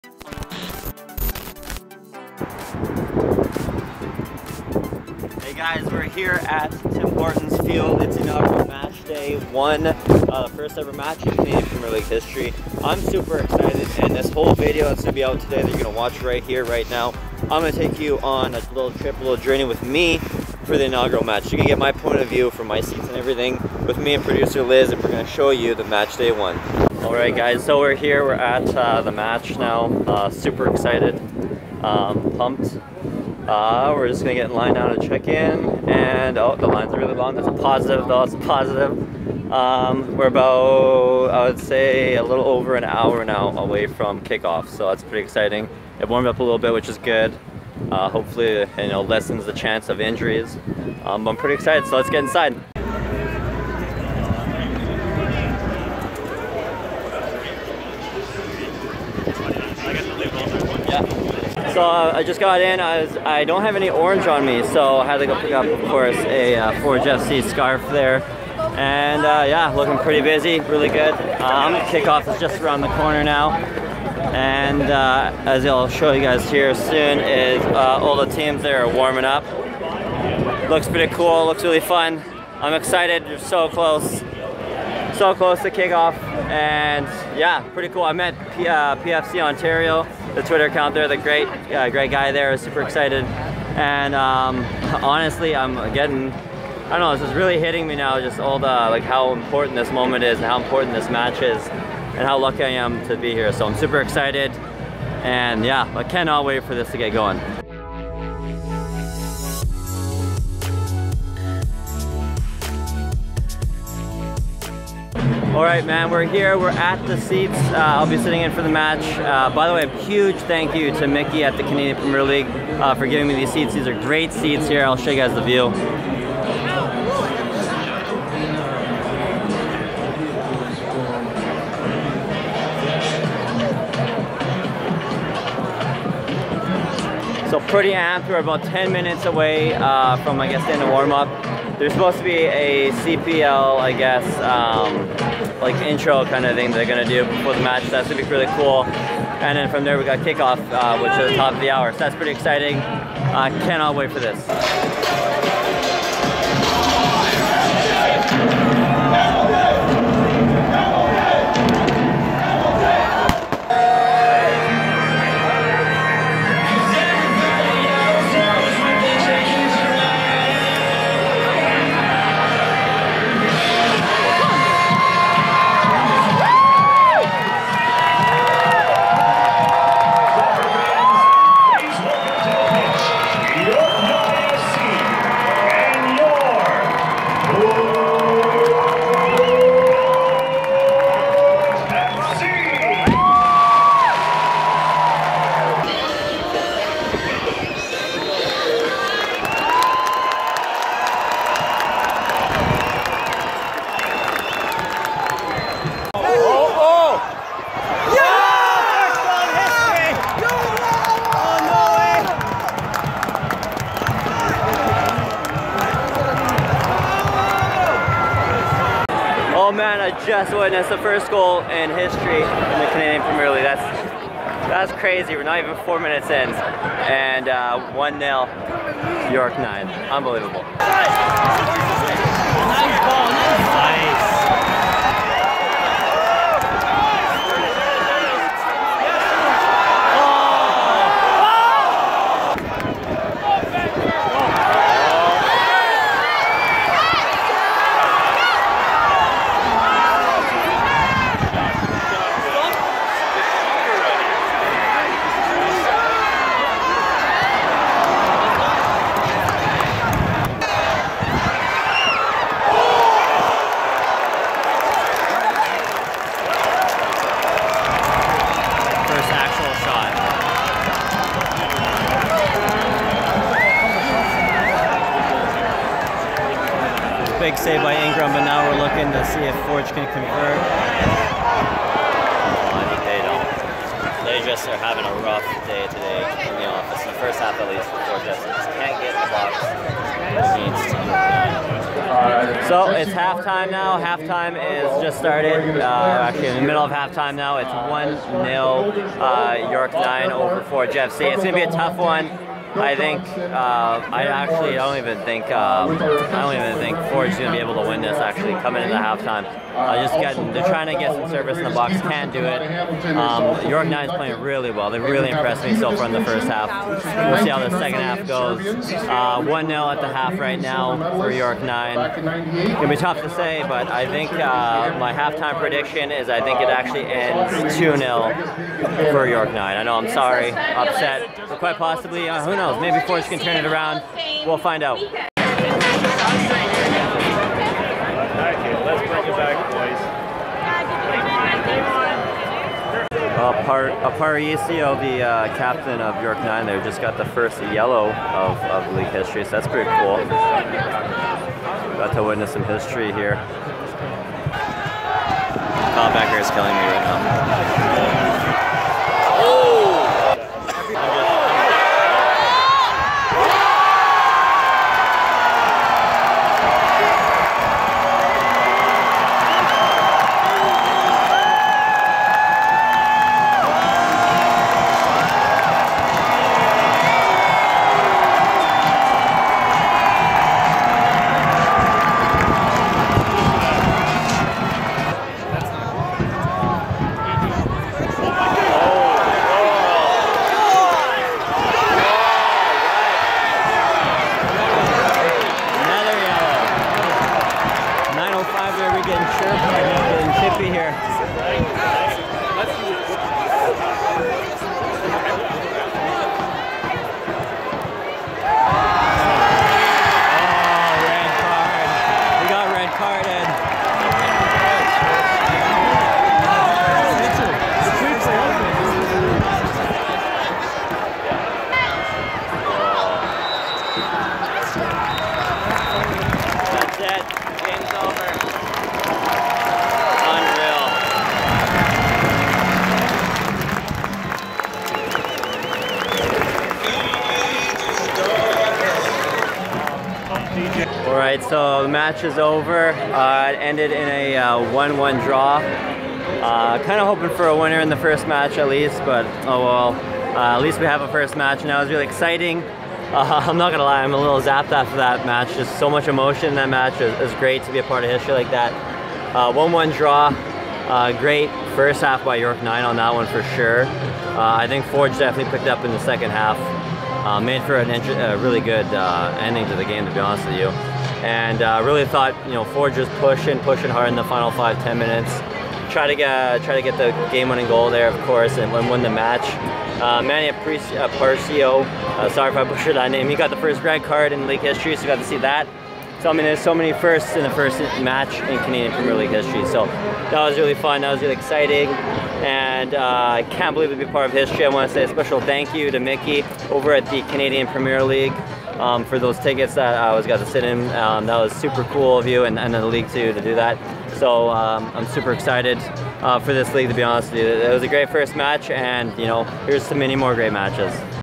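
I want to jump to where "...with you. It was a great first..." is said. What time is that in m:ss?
8:27.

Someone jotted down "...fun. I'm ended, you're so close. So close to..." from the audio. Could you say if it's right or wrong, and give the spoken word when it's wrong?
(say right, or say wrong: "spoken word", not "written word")
wrong: "excited", not "ended".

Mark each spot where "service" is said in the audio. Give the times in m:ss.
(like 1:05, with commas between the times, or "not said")
5:11.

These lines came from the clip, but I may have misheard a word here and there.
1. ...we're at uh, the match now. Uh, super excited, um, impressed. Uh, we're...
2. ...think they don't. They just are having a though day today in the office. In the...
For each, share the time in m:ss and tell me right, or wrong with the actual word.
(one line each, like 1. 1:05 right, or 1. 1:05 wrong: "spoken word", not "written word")
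1. 0:28 wrong: "pumped", not "impressed"
2. 4:42 wrong: "rough", not "though".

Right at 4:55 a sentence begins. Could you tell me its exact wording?
Uh, actually, in the middle of halftime now.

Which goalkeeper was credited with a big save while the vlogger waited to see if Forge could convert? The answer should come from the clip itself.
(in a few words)
Ingram.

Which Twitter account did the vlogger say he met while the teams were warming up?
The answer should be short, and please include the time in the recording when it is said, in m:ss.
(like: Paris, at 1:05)
PFC Ontario, at 1:28.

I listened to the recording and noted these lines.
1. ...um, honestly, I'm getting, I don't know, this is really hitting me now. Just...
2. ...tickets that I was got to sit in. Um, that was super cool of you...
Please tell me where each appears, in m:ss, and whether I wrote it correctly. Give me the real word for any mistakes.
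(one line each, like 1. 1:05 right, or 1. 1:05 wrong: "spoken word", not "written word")
1. 1:34 right
2. 8:19 right.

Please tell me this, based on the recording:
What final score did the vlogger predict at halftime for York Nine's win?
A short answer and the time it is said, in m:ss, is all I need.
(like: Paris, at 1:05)
2-0, at 5:27.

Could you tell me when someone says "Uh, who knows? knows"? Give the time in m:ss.
5:32.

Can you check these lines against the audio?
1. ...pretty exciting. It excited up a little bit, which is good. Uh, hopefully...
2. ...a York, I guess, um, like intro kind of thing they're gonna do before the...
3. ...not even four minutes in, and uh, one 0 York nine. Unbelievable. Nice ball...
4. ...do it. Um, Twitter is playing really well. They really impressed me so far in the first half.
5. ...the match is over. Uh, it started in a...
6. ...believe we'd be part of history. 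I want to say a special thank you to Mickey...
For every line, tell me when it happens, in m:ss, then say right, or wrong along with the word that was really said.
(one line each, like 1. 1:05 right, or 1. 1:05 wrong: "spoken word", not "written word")
1. 0:45 wrong: "warmed", not "excited"
2. 2:22 wrong: "CPL", not "York"
3. 3:45 right
4. 5:12 wrong: "York", not "Twitter"
5. 7:21 wrong: "ended", not "started"
6. 8:13 right.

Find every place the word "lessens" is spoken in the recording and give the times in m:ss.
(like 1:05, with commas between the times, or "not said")
0:49.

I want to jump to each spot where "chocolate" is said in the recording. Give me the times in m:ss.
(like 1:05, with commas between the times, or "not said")
not said.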